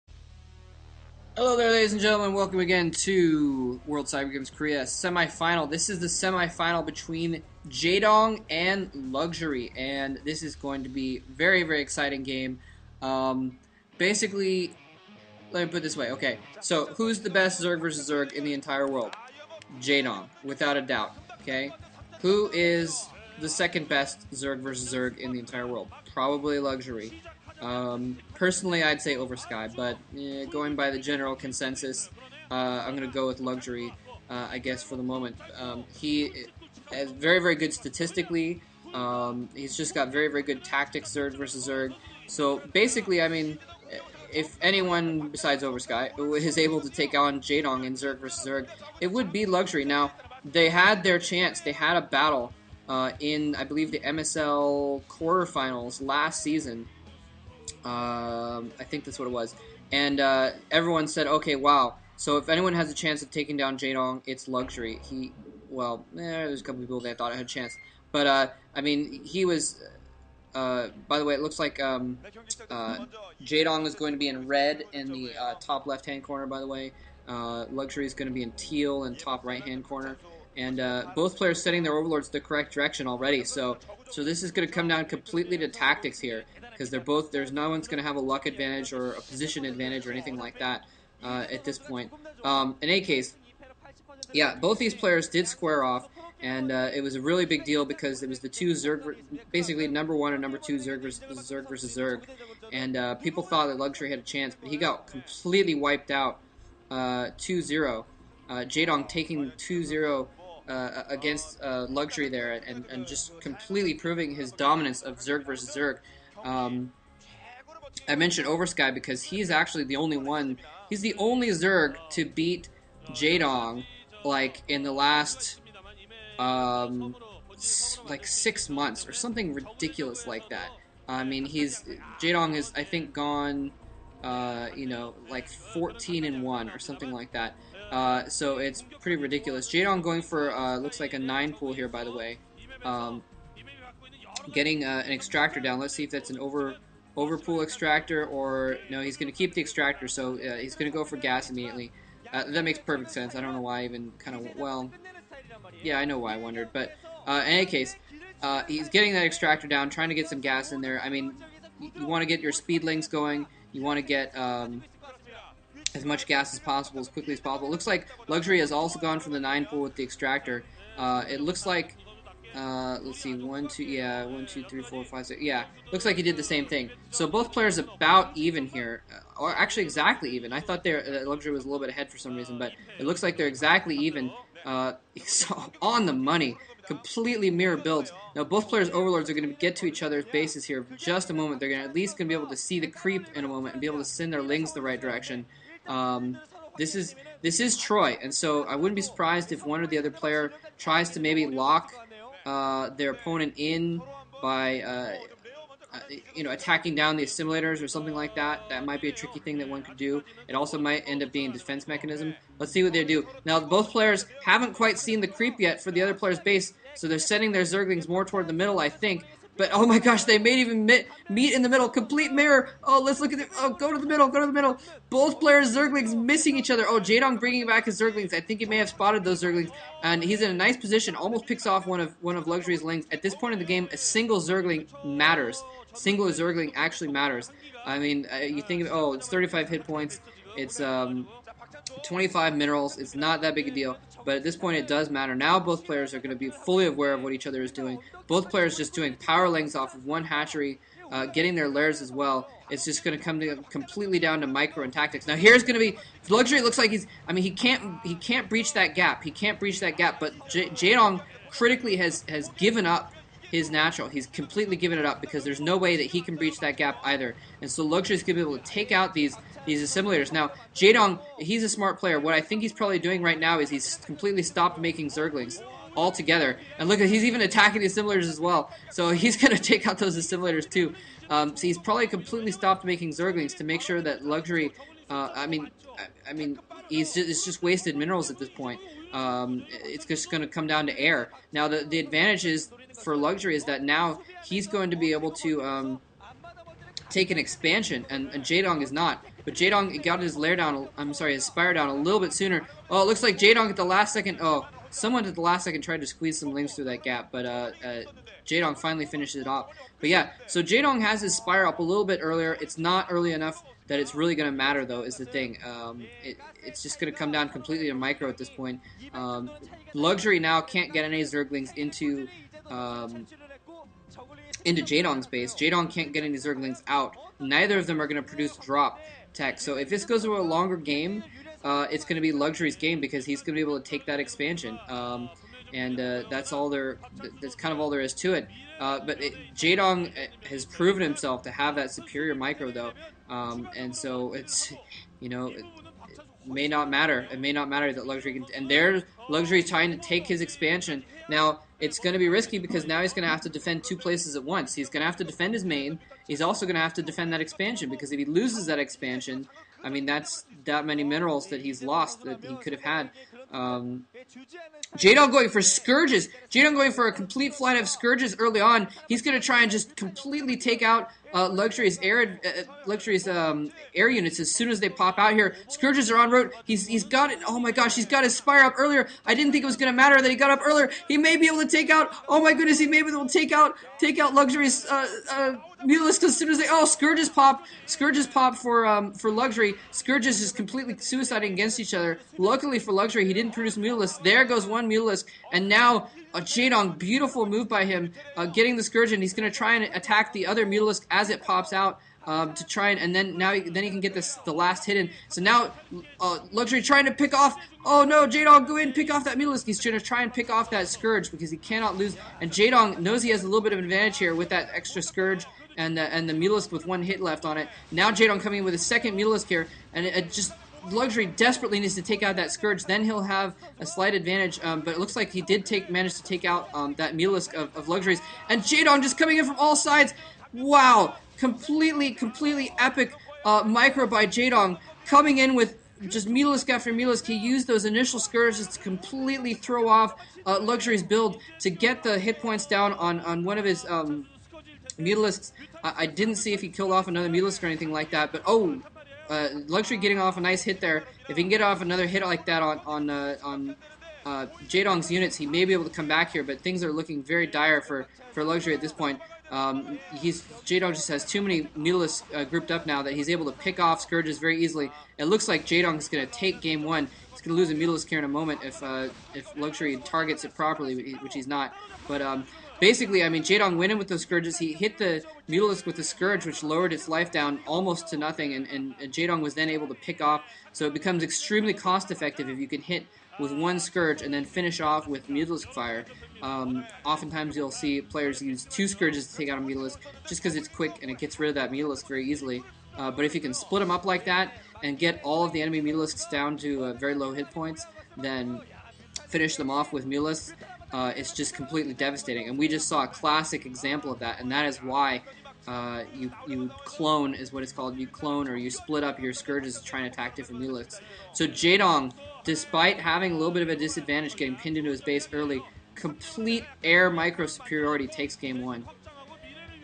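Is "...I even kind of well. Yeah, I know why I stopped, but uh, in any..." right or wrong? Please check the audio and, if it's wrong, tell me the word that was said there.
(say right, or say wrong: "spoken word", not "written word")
wrong: "wondered", not "stopped".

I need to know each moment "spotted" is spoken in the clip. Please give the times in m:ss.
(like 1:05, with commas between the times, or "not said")
3:48.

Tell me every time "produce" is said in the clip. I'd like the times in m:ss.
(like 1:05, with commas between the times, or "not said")
5:28, 6:33.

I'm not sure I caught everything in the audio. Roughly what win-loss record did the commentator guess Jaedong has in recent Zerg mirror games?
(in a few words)
14 and 1.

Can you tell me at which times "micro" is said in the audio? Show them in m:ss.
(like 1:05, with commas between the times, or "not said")
4:14, 5:17, 5:42, 7:13, 8:37.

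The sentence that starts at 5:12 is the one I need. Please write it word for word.
It's not early enough that it's really going to matter, though, is the thing.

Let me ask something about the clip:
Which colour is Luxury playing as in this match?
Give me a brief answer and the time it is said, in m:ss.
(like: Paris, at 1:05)
Teal, at 1:18.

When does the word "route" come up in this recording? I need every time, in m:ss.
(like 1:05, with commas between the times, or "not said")
6:16.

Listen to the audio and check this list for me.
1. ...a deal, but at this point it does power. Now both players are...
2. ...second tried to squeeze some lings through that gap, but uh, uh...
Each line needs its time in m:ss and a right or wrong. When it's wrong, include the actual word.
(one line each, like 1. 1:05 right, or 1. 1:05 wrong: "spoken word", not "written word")
1. 4:03 wrong: "matter", not "power"
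2. 5:05 right.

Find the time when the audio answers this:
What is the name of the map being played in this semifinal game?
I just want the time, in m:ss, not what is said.
3:17.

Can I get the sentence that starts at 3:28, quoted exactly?
That might be a tricky thing that one could do.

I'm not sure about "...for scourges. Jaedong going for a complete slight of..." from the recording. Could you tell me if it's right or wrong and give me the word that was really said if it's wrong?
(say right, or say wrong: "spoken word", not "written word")
wrong: "flight", not "slight".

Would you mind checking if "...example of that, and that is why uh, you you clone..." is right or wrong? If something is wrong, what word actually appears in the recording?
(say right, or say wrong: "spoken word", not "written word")
right.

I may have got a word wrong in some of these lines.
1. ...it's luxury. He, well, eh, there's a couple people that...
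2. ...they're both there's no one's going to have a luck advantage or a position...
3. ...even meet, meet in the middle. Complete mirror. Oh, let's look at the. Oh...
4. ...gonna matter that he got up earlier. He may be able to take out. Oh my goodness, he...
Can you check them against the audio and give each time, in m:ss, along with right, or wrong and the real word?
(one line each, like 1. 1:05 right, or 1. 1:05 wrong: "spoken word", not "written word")
1. 1:04 right
2. 1:26 right
3. 3:40 right
4. 6:19 right.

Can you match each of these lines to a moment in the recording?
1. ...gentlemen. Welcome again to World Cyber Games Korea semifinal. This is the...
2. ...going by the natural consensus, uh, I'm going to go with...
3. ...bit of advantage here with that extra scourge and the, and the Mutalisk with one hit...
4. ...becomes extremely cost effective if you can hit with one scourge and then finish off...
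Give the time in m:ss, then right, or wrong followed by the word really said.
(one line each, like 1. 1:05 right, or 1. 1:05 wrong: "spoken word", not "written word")
1. 0:02 right
2. 0:30 wrong: "general", not "natural"
3. 6:53 wrong: "Mulisk", not "Mutalisk"
4. 8:00 right.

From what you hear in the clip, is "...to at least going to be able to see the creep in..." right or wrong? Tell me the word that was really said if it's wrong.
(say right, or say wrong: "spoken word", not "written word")
right.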